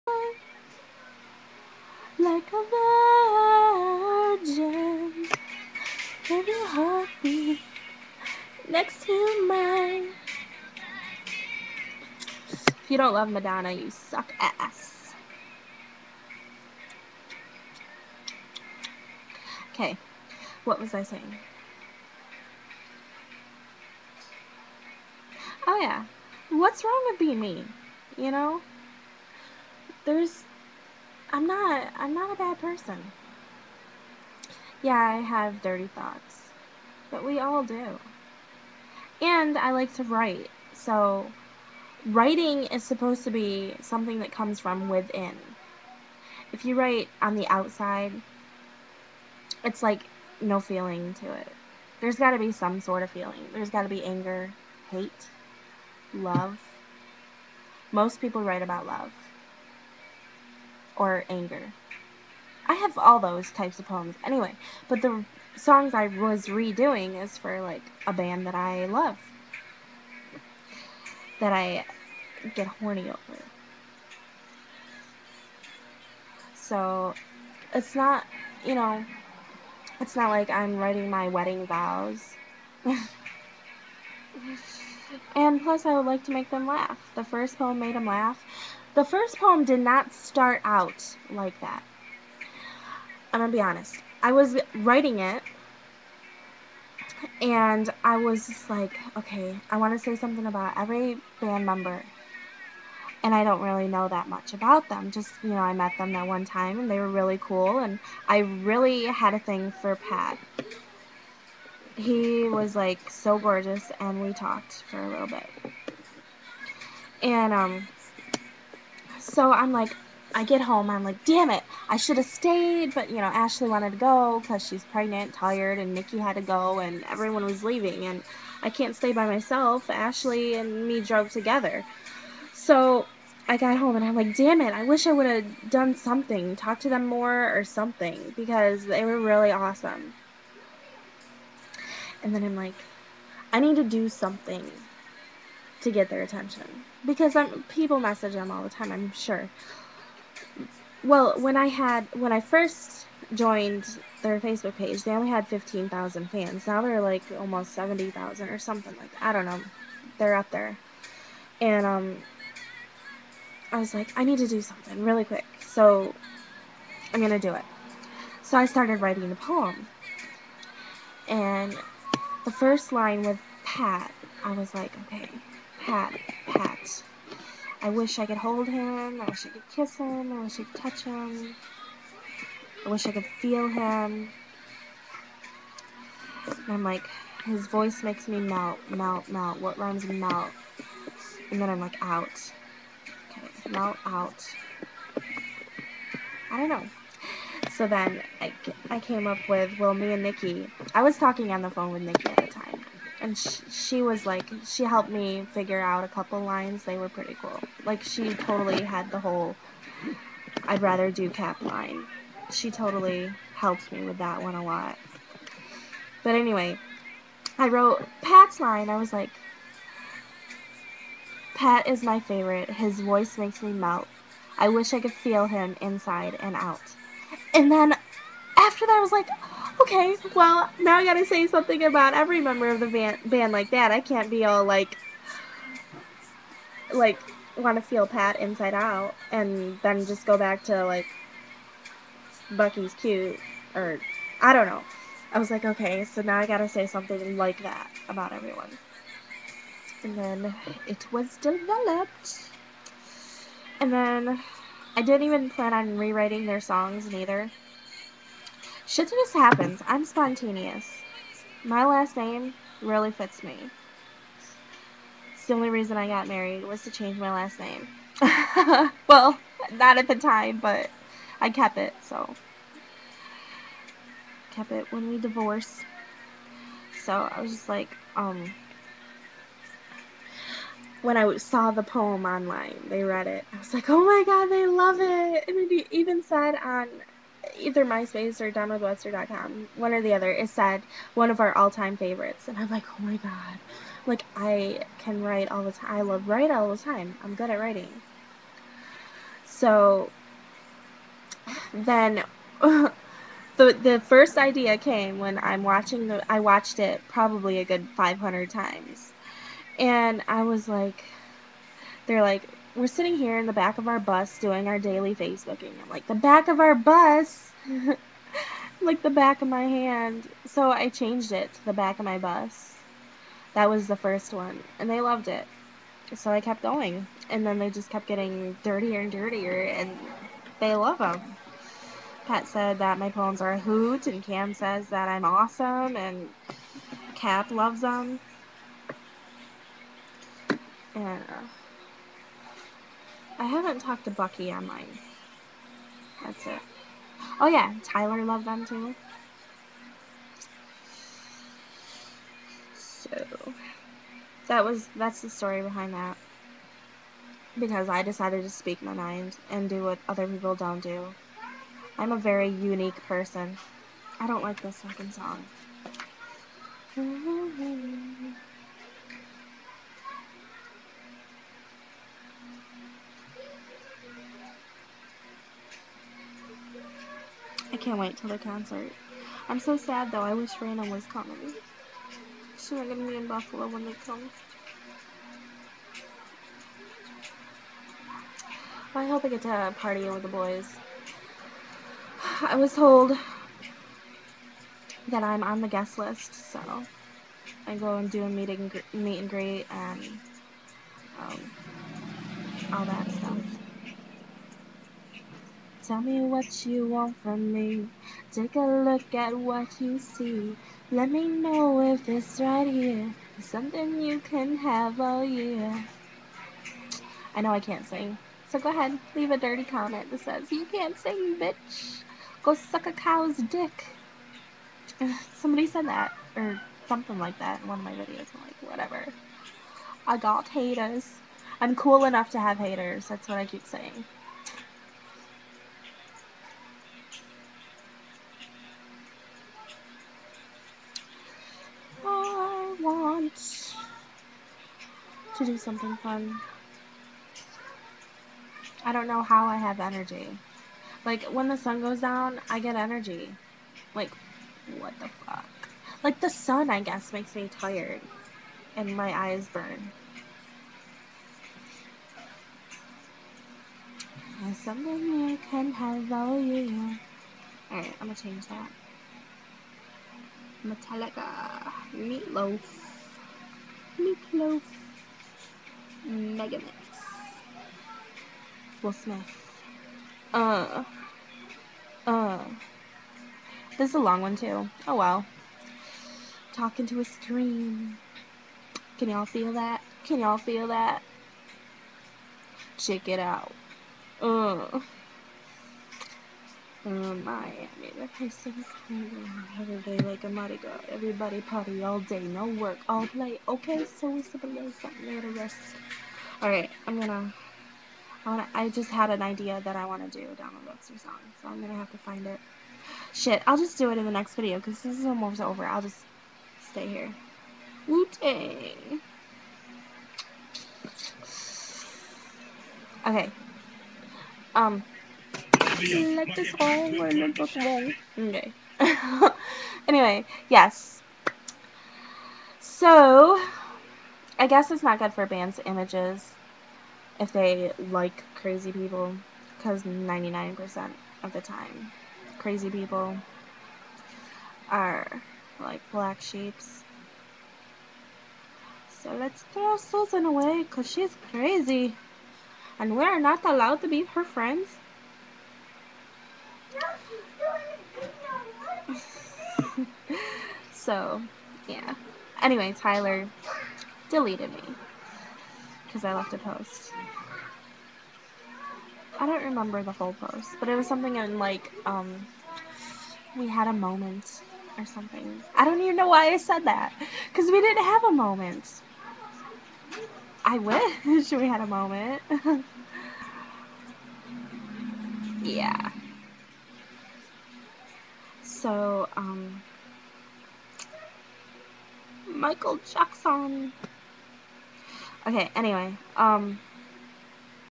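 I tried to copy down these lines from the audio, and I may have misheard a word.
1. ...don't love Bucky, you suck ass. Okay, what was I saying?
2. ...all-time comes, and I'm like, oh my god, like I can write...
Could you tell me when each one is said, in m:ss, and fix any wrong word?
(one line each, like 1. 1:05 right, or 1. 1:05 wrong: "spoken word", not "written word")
1. 0:12 wrong: "Madonna", not "Bucky"
2. 4:51 wrong: "favorites", not "comes".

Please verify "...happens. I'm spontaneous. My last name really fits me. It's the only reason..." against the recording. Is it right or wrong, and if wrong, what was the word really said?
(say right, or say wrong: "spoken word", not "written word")
right.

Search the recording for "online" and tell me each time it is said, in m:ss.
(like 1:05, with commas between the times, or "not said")
4:42, 5:44.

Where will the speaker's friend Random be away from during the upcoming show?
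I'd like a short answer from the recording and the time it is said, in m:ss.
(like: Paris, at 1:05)
Buffalo, at 6:23.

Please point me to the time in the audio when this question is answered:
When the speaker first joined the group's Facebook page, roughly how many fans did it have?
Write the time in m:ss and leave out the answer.
2:35.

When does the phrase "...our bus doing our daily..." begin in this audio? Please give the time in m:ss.
5:13.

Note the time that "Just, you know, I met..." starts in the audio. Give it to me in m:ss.
1:45.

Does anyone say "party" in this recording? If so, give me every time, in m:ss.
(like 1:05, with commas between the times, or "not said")
6:29, 8:21.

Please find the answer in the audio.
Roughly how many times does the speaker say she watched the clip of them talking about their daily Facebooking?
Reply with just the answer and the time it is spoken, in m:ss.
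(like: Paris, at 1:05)
500, at 5:07.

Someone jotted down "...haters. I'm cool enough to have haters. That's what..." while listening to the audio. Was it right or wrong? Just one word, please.
right.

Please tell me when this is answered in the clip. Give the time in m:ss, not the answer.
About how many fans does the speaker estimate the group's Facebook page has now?
2:37.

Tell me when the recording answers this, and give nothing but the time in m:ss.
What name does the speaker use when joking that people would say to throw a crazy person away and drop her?
9:09.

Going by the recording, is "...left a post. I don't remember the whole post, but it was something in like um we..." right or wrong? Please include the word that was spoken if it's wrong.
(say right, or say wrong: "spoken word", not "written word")
right.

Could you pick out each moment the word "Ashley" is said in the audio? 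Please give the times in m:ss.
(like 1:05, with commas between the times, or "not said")
2:03, 2:09.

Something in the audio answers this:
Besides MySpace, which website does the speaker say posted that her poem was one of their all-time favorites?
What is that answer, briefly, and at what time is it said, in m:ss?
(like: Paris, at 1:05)
DownWithWebster.com, at 4:48.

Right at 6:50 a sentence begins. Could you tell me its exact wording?
Let me know if it's right here.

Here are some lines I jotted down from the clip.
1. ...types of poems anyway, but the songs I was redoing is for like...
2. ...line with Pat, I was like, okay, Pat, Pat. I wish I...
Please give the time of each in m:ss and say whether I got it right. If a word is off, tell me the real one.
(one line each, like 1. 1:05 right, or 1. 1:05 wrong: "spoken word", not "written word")
1. 1:03 right
2. 2:52 right.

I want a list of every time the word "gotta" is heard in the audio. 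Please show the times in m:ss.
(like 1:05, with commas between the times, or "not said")
3:51, 4:06.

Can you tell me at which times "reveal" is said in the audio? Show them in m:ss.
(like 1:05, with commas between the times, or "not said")
not said.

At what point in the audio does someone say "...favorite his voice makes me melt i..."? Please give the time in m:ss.
3:42.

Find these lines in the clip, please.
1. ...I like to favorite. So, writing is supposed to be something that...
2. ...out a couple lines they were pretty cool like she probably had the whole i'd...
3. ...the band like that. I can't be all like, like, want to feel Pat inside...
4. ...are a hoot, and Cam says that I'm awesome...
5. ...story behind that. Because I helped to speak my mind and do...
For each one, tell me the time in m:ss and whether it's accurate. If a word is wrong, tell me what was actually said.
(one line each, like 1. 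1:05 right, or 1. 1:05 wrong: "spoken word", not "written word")
1. 0:39 wrong: "write", not "favorite"
2. 3:25 wrong: "totally", not "probably"
3. 3:52 right
4. 5:33 right
5. 5:55 wrong: "decided", not "helped".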